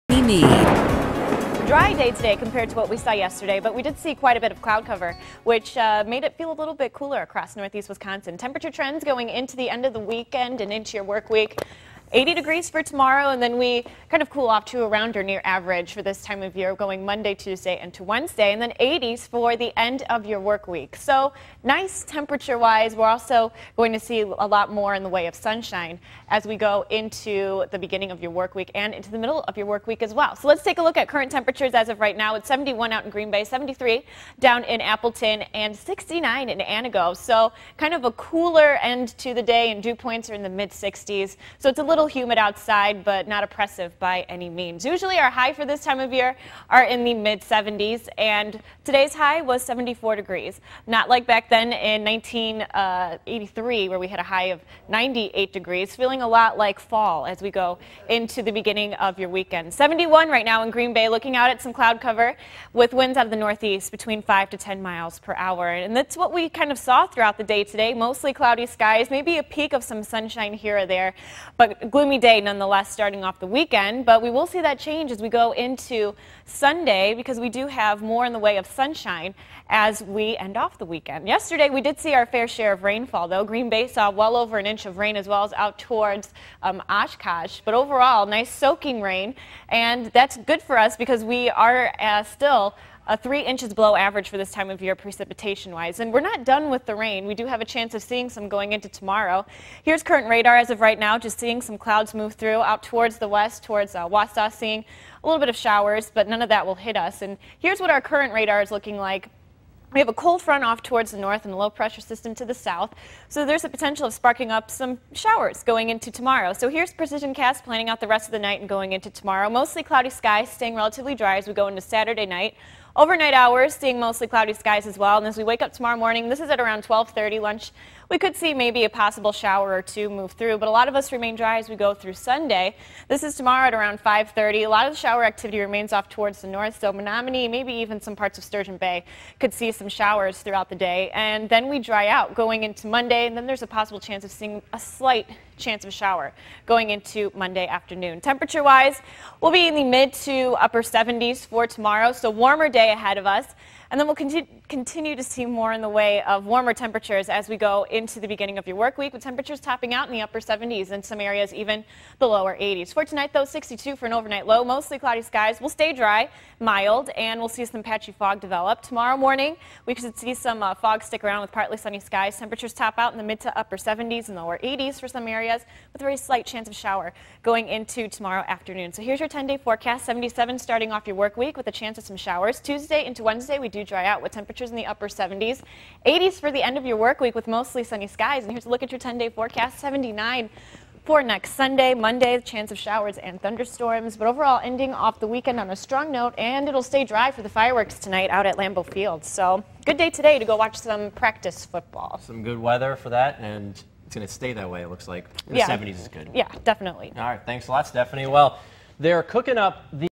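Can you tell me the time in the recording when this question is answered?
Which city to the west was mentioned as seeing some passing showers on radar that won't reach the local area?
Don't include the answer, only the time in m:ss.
1:44.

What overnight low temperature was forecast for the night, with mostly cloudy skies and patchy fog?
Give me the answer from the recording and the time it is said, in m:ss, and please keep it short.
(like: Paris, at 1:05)
62, at 2:43.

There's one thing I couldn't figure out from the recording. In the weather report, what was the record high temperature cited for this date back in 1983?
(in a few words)
98 degrees.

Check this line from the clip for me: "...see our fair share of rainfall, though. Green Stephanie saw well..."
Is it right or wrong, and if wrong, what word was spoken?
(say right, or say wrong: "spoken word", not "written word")
wrong: "Bay", not "Stephanie".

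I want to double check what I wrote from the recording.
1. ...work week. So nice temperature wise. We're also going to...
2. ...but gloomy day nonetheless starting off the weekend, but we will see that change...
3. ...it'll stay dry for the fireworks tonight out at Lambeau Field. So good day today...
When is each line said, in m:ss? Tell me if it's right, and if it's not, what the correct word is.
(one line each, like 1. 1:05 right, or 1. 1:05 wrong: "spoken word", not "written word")
1. 0:20 right
2. 1:11 right
3. 3:16 right.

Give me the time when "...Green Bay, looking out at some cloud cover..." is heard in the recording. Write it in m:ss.
1:00.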